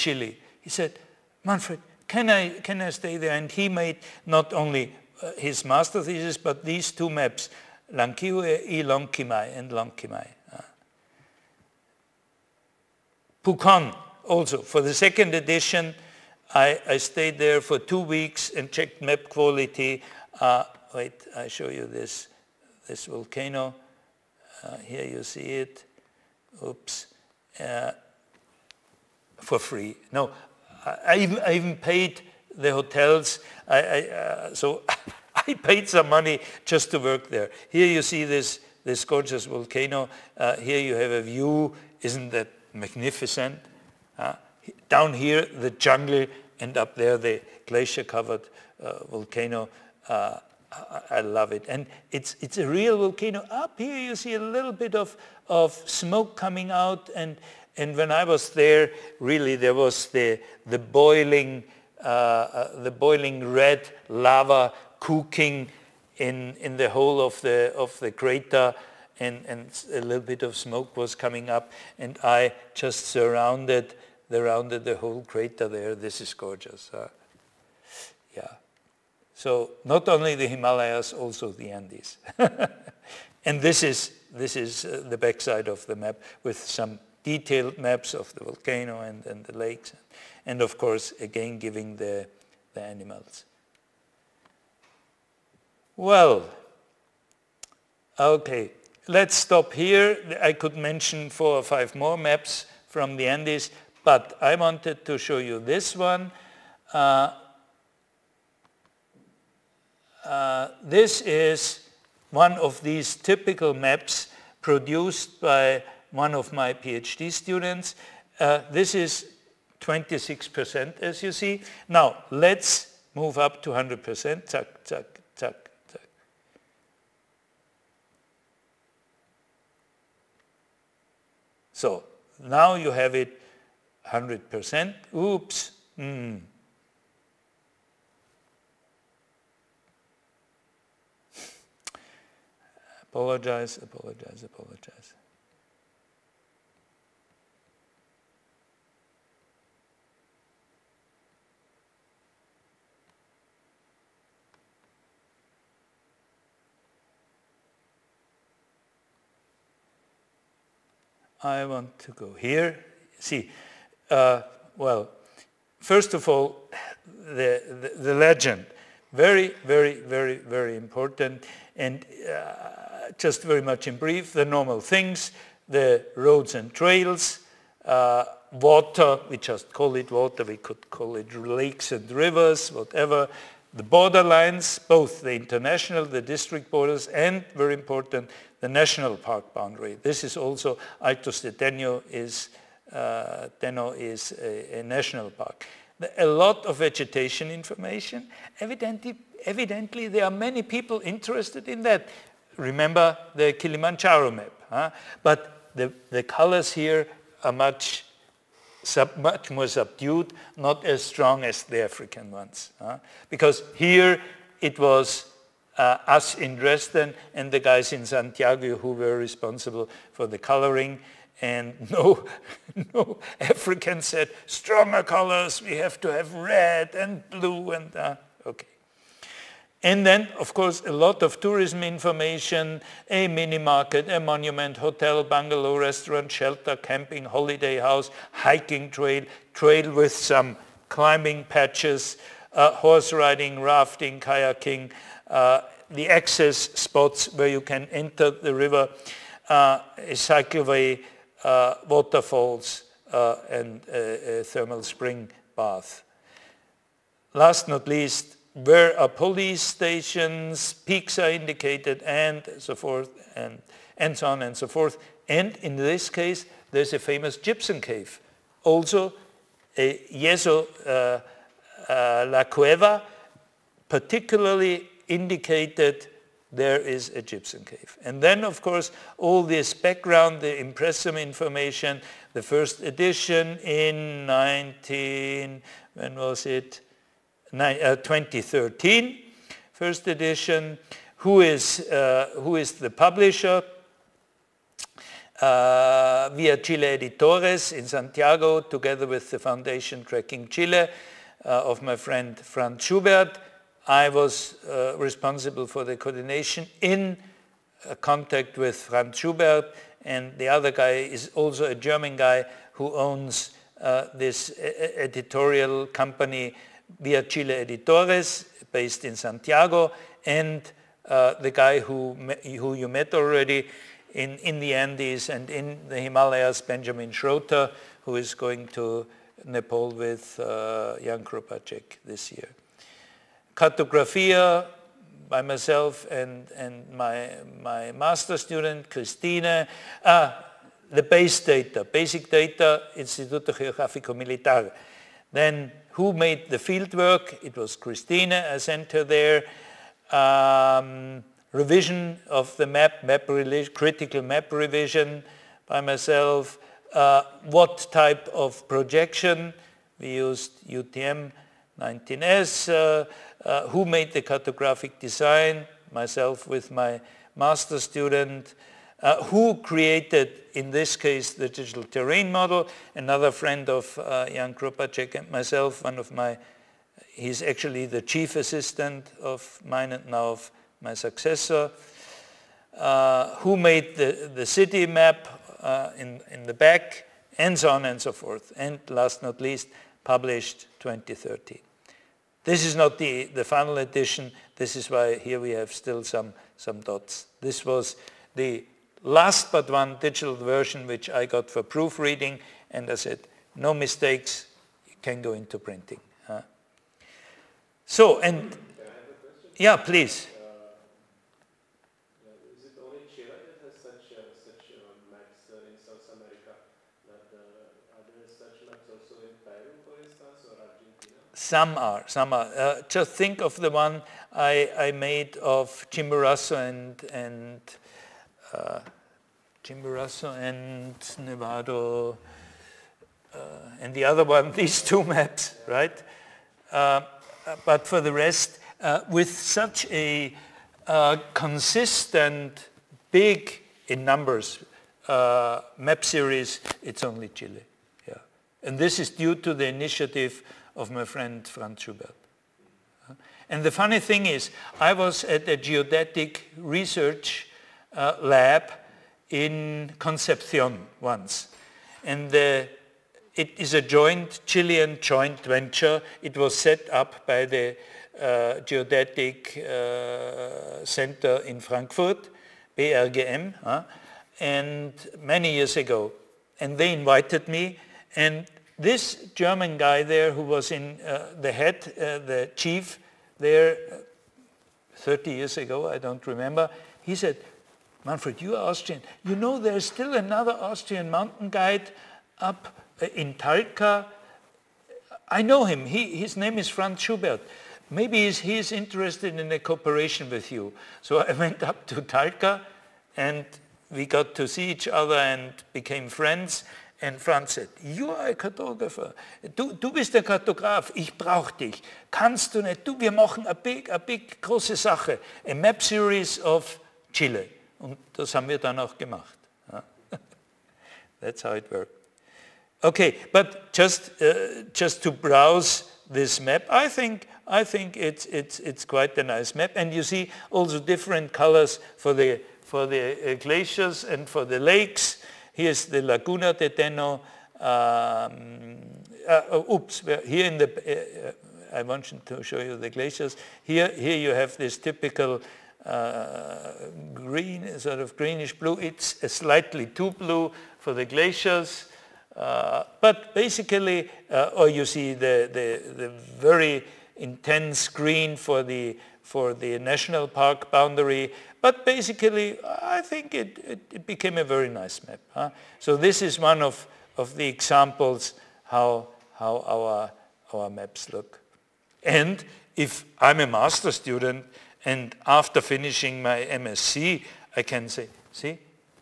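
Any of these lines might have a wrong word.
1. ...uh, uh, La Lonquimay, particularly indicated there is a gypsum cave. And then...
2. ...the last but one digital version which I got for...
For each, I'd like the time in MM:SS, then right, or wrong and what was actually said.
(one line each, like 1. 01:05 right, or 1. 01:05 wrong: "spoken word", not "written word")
1. 04:30 wrong: "Cueva", not "Lonquimay"
2. 06:38 right.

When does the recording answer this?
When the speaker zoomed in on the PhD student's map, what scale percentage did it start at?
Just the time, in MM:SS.
01:59.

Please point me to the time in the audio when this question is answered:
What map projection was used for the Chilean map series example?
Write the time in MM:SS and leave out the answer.
06:00.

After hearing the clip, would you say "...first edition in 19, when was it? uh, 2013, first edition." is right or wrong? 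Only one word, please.
right.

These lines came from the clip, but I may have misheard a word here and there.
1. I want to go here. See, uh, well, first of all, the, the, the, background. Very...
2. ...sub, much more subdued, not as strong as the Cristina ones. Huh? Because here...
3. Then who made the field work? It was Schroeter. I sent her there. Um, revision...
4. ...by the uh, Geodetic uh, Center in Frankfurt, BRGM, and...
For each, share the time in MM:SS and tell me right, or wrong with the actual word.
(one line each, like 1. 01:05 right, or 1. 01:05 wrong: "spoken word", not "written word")
1. 02:41 wrong: "legend", not "background"
2. 03:28 wrong: "African", not "Cristina"
3. 05:45 wrong: "Christina", not "Schroeter"
4. 07:47 right.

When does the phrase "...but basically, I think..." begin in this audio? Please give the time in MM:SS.
09:21.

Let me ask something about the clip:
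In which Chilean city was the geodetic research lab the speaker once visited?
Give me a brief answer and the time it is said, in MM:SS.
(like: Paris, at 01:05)
Concepcion, at 07:39.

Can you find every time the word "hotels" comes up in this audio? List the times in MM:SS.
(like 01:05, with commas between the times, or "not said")
00:32, 03:54.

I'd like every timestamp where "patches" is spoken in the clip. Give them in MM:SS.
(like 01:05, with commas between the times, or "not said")
04:01.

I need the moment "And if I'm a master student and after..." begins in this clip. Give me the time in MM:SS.
09:32.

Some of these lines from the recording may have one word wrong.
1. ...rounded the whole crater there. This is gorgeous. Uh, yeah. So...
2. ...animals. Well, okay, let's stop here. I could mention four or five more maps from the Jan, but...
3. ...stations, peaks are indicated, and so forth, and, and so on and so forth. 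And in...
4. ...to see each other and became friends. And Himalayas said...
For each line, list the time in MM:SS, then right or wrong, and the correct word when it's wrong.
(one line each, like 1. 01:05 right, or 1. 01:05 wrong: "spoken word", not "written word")
1. 01:14 right
2. 01:32 wrong: "Andes", not "Jan"
3. 04:19 right
4. 08:24 wrong: "Franz", not "Himalayas".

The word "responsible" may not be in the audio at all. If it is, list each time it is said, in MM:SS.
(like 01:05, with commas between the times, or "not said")
03:39, 05:04.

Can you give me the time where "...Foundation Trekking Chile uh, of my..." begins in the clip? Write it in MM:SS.
04:59.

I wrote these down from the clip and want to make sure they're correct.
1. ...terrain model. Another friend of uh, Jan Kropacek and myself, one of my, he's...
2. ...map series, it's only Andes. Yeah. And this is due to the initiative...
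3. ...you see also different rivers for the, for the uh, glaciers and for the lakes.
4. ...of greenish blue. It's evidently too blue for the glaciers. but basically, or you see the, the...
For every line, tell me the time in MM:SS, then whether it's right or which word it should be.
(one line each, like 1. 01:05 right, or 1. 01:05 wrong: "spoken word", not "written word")
1. 06:11 right
2. 07:25 wrong: "Chile", not "Andes"
3. 08:49 wrong: "colors", not "rivers"
4. 09:07 wrong: "slightly", not "evidently".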